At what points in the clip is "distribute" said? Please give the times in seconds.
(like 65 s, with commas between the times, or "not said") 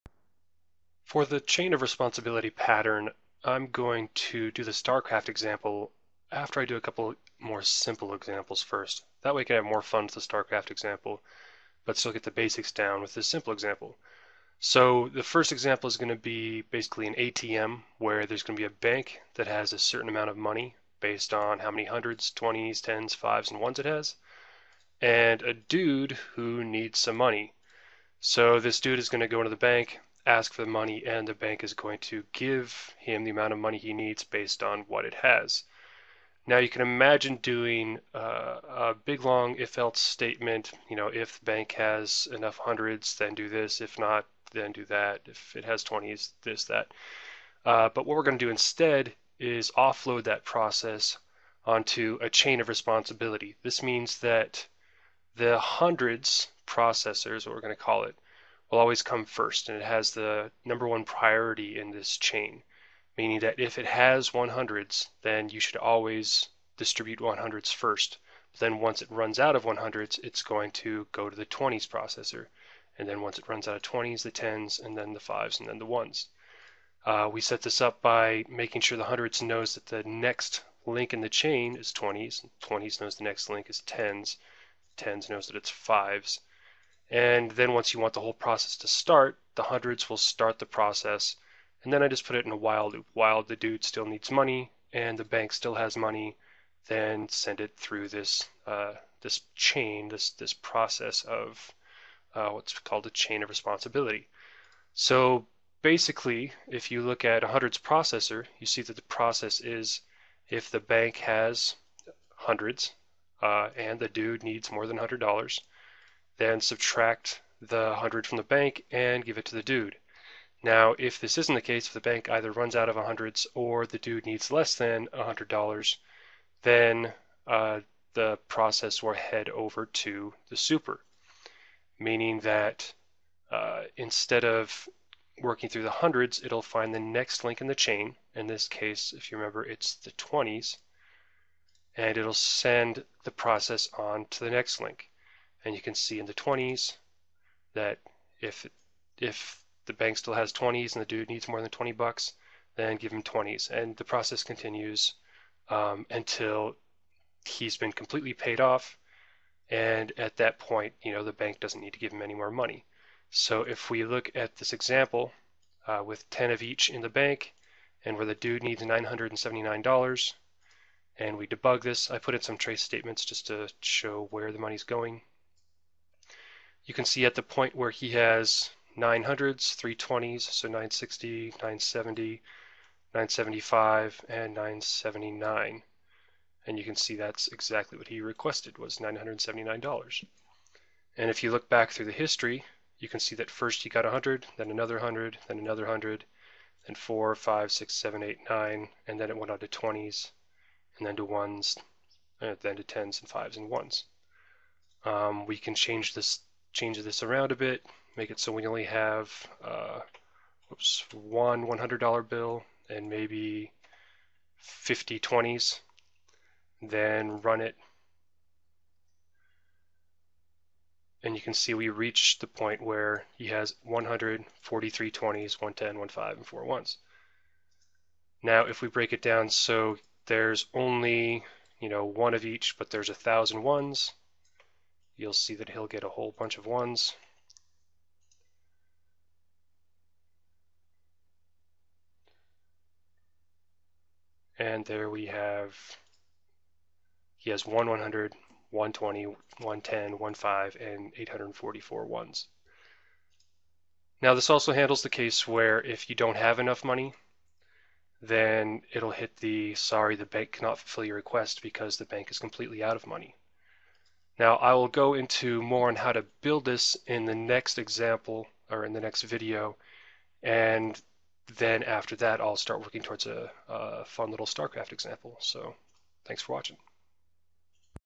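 66 s.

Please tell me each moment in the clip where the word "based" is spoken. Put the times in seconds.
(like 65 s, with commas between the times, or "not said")
21 s, 34 s.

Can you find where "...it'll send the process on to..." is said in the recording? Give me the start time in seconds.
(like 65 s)
142 s.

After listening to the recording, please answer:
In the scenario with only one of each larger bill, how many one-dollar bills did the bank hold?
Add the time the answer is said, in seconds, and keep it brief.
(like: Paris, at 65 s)
1000, at 233 s.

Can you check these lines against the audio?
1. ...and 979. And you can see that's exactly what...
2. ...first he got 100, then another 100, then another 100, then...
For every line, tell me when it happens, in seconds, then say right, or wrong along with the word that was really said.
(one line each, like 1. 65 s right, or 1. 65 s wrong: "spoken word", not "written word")
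1. 184 s right
2. 193 s right.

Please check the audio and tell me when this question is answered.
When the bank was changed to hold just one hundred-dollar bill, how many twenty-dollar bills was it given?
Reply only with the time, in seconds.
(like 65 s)
214 s.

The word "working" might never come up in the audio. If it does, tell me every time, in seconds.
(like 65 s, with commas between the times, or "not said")
135 s, 272 s.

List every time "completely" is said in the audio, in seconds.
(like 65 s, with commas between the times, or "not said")
157 s, 262 s.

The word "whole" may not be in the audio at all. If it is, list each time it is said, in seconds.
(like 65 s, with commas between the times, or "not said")
88 s, 236 s.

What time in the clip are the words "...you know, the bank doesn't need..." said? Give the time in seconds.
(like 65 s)
161 s.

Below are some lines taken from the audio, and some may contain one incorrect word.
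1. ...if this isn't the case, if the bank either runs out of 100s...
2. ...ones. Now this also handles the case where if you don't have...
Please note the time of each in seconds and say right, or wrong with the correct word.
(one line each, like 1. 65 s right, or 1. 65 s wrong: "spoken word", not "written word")
1. 120 s right
2. 252 s right.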